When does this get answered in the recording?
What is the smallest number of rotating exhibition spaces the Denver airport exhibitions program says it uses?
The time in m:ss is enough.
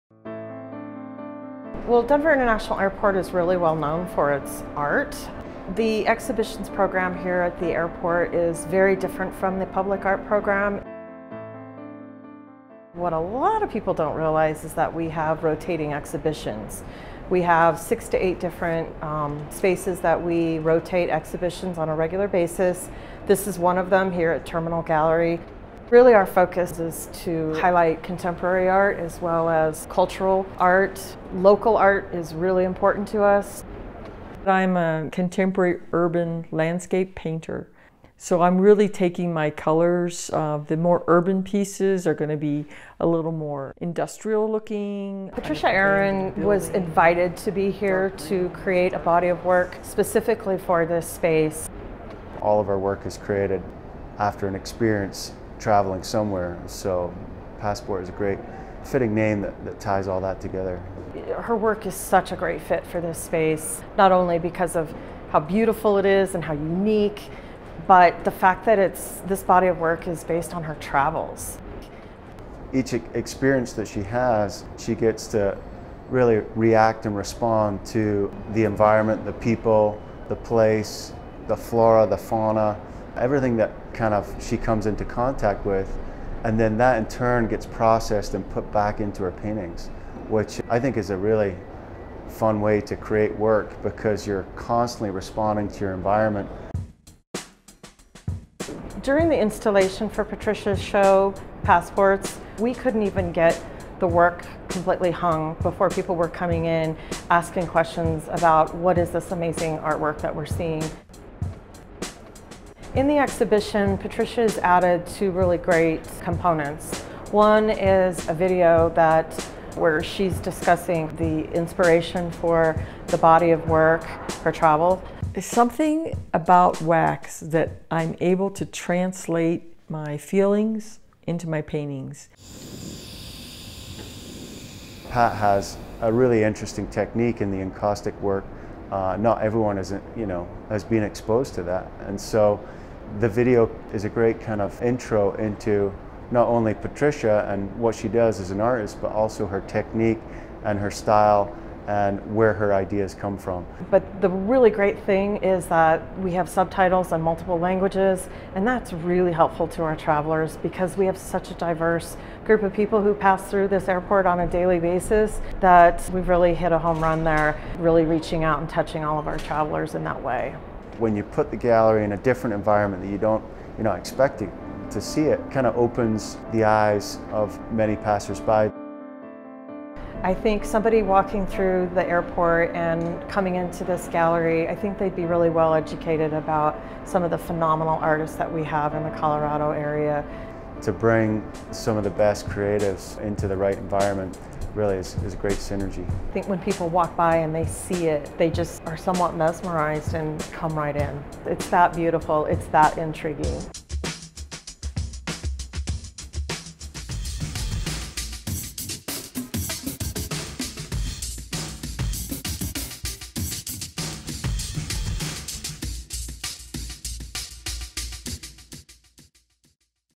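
0:17.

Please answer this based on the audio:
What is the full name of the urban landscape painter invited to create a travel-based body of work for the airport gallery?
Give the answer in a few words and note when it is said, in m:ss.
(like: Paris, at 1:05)
Patricia Aaron, at 0:45.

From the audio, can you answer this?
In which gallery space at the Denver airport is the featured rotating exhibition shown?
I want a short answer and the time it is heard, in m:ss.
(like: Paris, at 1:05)
Terminal Gallery, at 0:24.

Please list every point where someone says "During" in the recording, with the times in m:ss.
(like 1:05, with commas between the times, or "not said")
1:39.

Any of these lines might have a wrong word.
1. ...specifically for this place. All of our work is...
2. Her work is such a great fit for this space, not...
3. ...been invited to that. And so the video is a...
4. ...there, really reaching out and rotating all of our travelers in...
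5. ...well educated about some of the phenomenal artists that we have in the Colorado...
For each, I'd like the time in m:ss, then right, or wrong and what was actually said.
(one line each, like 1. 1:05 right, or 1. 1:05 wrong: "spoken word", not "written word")
1. 0:49 wrong: "space", not "place"
2. 1:01 right
3. 2:20 wrong: "exposed", not "invited"
4. 2:47 wrong: "touching", not "rotating"
5. 3:05 right.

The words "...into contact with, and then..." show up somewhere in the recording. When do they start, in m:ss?
1:24.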